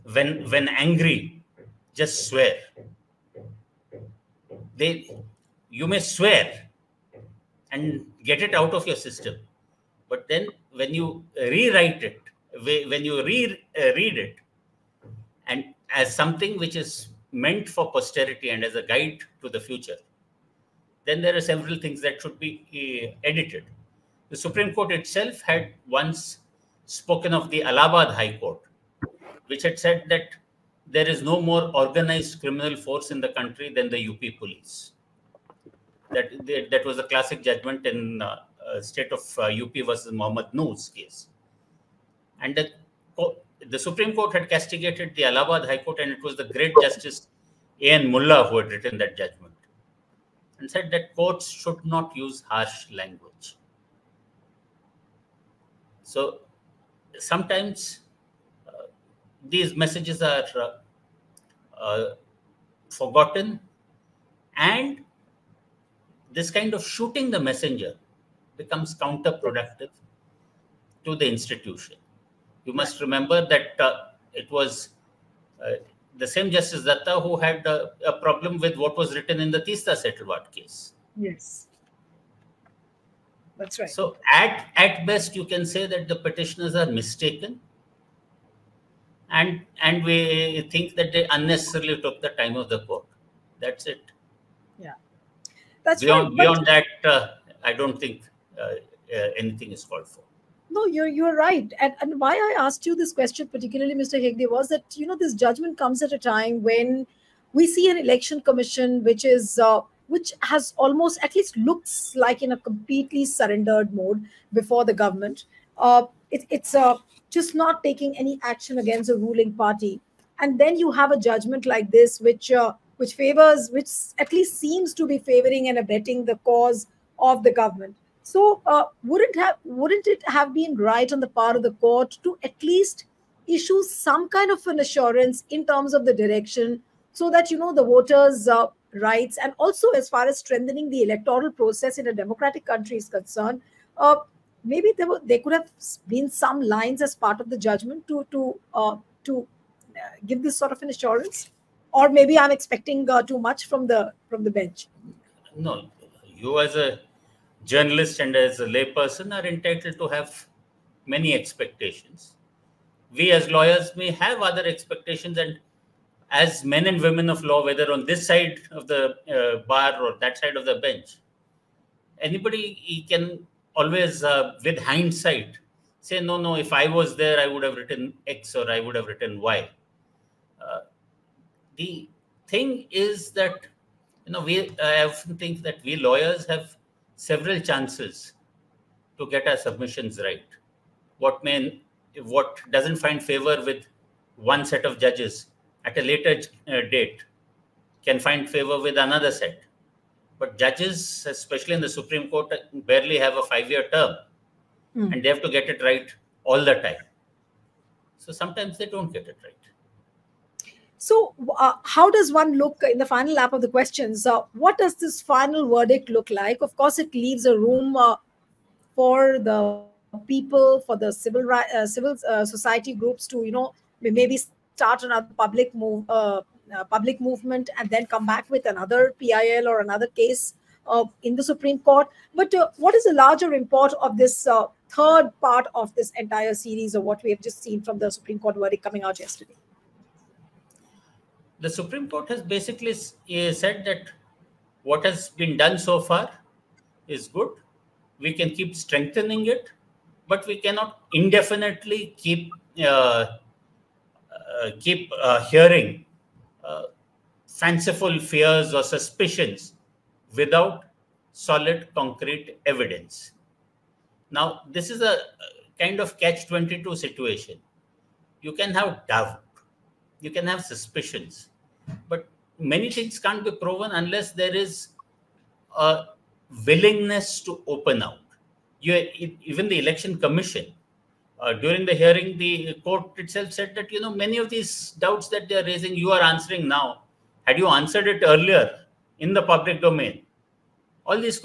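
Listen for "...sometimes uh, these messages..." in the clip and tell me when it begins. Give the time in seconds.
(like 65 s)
57 s.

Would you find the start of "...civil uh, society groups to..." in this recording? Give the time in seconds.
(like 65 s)
221 s.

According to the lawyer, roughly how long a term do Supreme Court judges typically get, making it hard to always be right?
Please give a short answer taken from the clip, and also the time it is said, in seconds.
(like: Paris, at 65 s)
5 years, at 203 s.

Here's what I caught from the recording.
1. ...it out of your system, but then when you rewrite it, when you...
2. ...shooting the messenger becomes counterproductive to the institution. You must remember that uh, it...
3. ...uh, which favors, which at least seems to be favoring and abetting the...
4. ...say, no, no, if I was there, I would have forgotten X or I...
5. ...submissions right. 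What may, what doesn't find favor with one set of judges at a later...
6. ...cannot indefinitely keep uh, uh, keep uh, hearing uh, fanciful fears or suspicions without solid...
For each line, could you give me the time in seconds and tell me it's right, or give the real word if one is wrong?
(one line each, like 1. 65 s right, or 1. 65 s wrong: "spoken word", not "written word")
1. 8 s right
2. 66 s right
3. 122 s right
4. 176 s wrong: "written", not "forgotten"
5. 189 s right
6. 250 s right.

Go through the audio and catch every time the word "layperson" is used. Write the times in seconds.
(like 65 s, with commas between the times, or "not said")
158 s.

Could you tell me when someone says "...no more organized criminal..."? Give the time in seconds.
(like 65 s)
31 s.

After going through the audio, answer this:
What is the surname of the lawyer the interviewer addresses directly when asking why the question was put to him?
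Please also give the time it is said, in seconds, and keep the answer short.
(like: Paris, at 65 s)
Hegde, at 104 s.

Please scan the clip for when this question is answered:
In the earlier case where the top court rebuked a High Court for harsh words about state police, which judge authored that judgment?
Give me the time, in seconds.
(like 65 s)
46 s.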